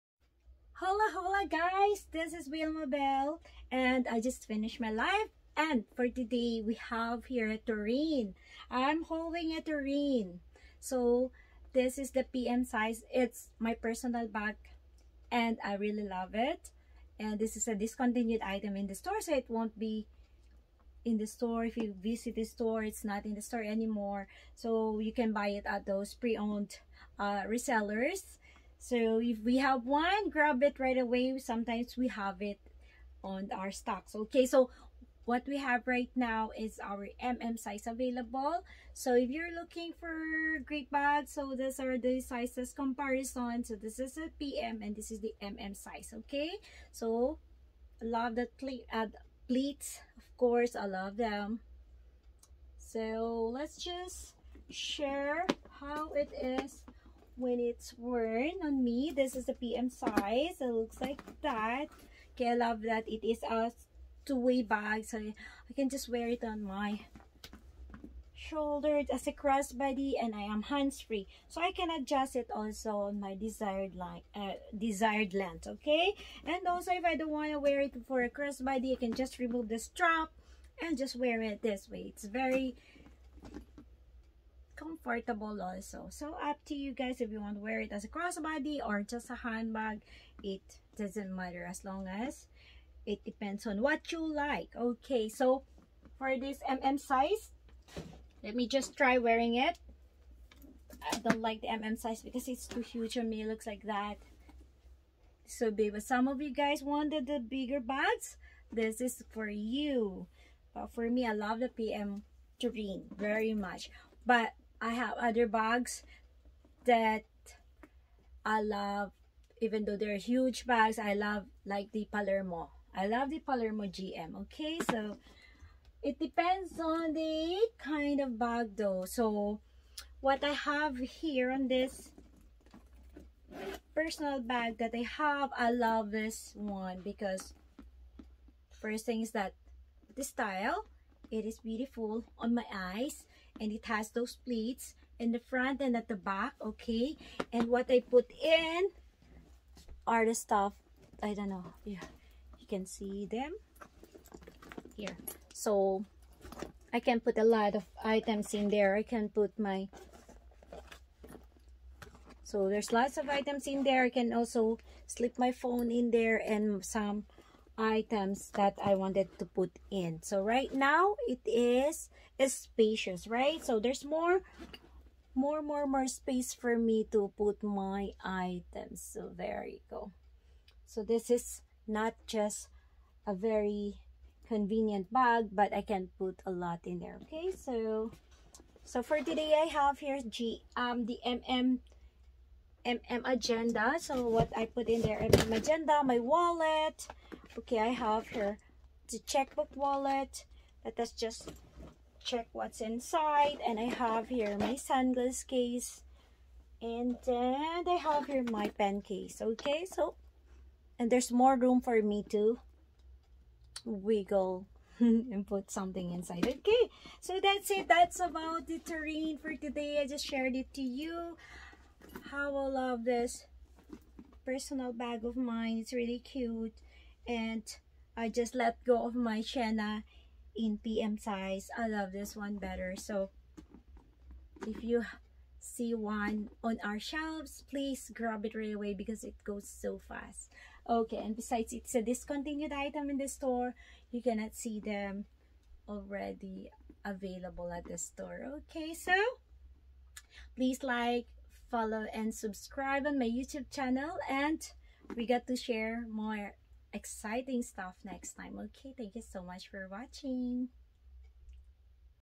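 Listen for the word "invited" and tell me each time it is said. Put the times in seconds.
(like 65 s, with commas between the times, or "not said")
not said.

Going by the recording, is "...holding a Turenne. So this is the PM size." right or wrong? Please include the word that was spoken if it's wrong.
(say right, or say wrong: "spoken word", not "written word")
right.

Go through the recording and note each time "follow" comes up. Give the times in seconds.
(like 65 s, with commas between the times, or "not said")
251 s.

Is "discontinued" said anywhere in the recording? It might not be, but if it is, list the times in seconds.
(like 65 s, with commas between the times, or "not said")
17 s, 242 s.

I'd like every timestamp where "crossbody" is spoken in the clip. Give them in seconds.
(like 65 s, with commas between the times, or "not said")
69 s, 78 s, 88 s.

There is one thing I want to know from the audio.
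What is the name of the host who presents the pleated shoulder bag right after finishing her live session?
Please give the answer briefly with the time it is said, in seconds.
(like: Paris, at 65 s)
Wilmabelle, at 2 s.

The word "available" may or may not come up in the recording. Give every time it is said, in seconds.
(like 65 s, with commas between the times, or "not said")
37 s, 247 s.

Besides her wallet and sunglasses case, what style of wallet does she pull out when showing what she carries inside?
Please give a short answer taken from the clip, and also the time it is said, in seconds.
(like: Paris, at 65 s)
checkbook wallet, at 199 s.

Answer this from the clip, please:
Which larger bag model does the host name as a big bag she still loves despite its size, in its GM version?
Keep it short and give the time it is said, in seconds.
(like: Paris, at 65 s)
Palermo GM, at 123 s.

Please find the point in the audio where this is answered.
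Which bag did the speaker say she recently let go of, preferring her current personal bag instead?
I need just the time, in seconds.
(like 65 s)
229 s.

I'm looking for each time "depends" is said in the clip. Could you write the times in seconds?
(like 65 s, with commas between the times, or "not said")
93 s, 126 s.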